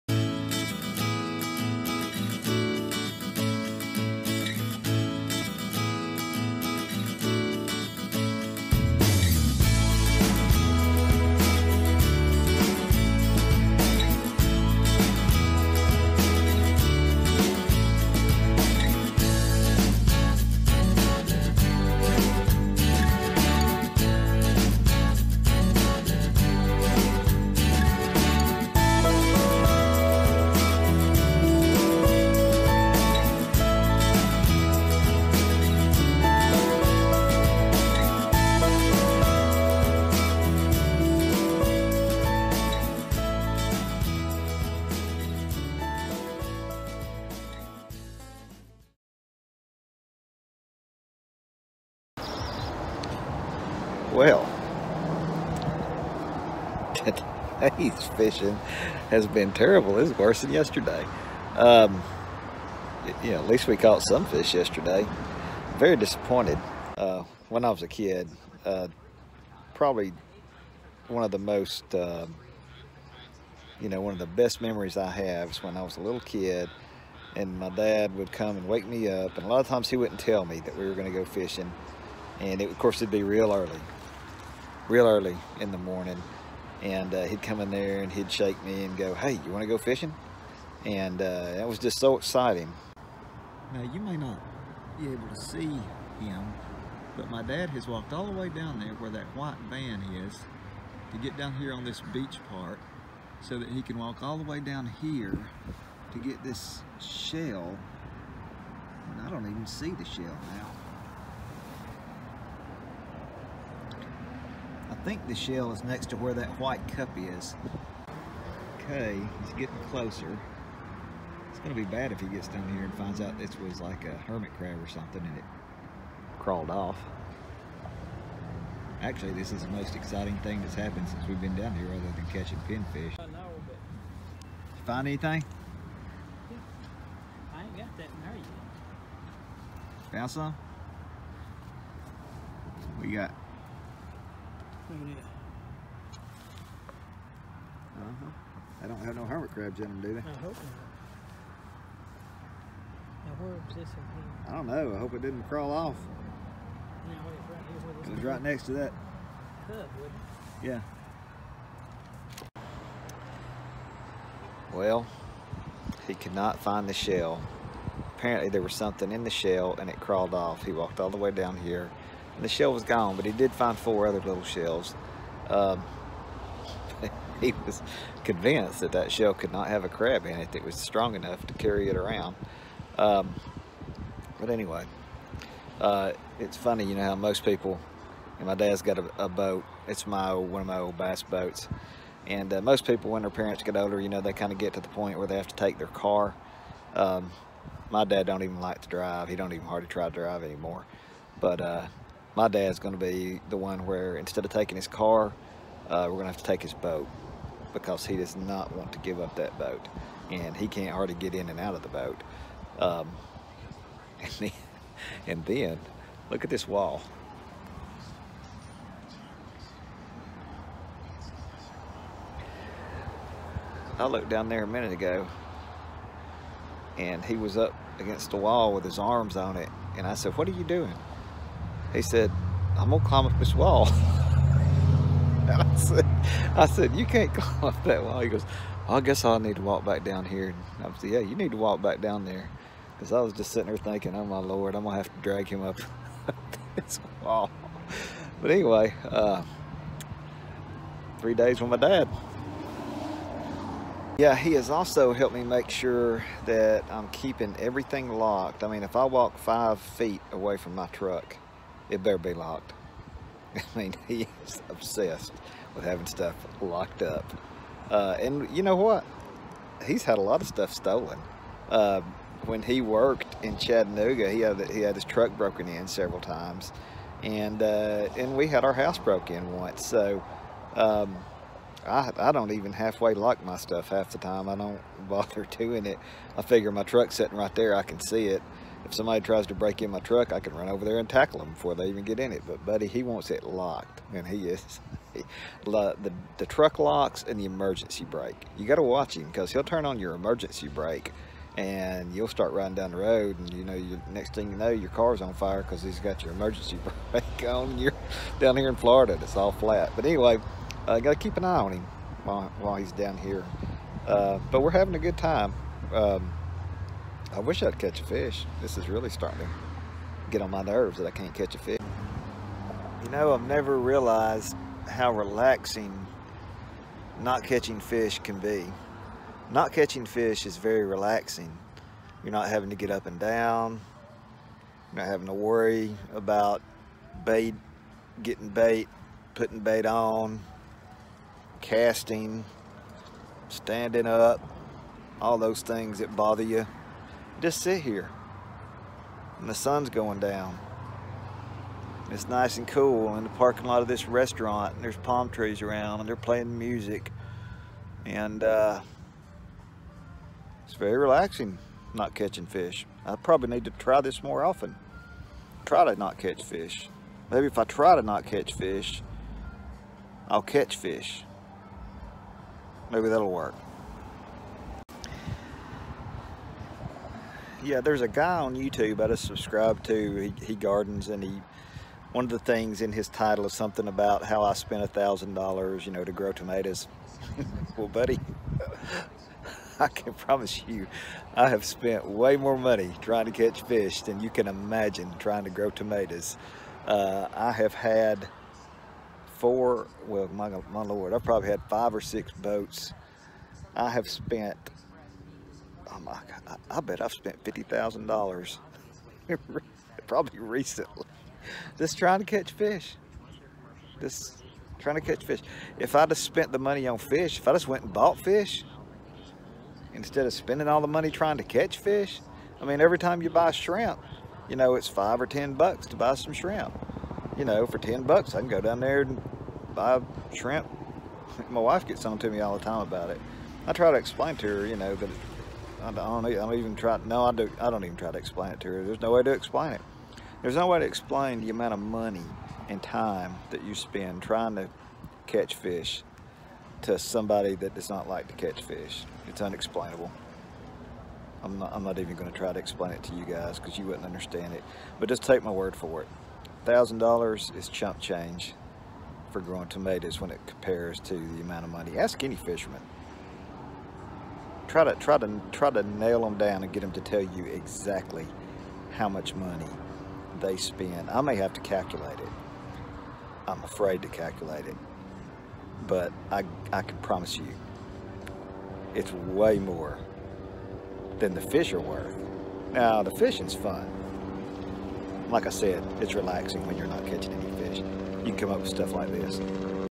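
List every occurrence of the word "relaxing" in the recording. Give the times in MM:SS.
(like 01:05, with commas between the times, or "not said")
05:25, 05:30, 06:00, 08:06.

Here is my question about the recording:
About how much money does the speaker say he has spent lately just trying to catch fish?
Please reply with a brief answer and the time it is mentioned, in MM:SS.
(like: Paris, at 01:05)
$50,000, at 06:47.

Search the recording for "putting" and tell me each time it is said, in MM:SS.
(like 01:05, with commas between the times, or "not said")
05:39.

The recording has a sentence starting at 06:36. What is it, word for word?
Uh, I have had four, well, my, my Lord, I've probably had five or six boats.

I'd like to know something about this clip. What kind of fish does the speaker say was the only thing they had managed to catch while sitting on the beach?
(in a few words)
Pinfish.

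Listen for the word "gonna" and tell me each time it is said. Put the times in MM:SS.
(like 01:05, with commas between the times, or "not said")
03:52, 04:04.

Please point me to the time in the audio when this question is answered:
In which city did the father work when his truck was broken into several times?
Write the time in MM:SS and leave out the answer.
04:33.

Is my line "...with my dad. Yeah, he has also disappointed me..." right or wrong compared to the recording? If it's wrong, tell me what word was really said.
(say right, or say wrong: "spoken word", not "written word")
wrong: "helped", not "disappointed".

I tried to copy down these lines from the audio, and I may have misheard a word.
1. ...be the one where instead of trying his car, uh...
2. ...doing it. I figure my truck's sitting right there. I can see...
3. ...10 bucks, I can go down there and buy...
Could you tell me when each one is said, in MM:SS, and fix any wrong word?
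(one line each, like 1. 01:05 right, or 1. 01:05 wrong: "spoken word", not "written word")
1. 03:23 wrong: "taking", not "trying"
2. 04:45 right
3. 07:07 right.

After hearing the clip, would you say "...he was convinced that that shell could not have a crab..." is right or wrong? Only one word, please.
right.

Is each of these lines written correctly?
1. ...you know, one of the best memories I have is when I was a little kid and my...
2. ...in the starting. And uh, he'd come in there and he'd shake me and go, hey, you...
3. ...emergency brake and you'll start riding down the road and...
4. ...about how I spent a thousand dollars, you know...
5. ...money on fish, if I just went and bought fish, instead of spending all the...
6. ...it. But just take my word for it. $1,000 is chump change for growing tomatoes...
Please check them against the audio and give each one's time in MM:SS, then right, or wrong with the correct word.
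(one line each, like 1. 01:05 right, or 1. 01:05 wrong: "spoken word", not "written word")
1. 01:13 right
2. 01:25 wrong: "morning", not "starting"
3. 05:00 right
4. 06:23 right
5. 06:56 right
6. 07:34 right.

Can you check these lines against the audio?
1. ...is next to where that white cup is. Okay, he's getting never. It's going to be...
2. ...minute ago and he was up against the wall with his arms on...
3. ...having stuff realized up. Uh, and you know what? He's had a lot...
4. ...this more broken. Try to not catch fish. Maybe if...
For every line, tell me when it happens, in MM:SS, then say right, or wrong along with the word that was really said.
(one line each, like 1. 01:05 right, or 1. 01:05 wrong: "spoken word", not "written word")
1. 01:55 wrong: "closer", not "never"
2. 03:44 right
3. 04:25 wrong: "locked", not "realized"
4. 06:04 wrong: "often", not "broken".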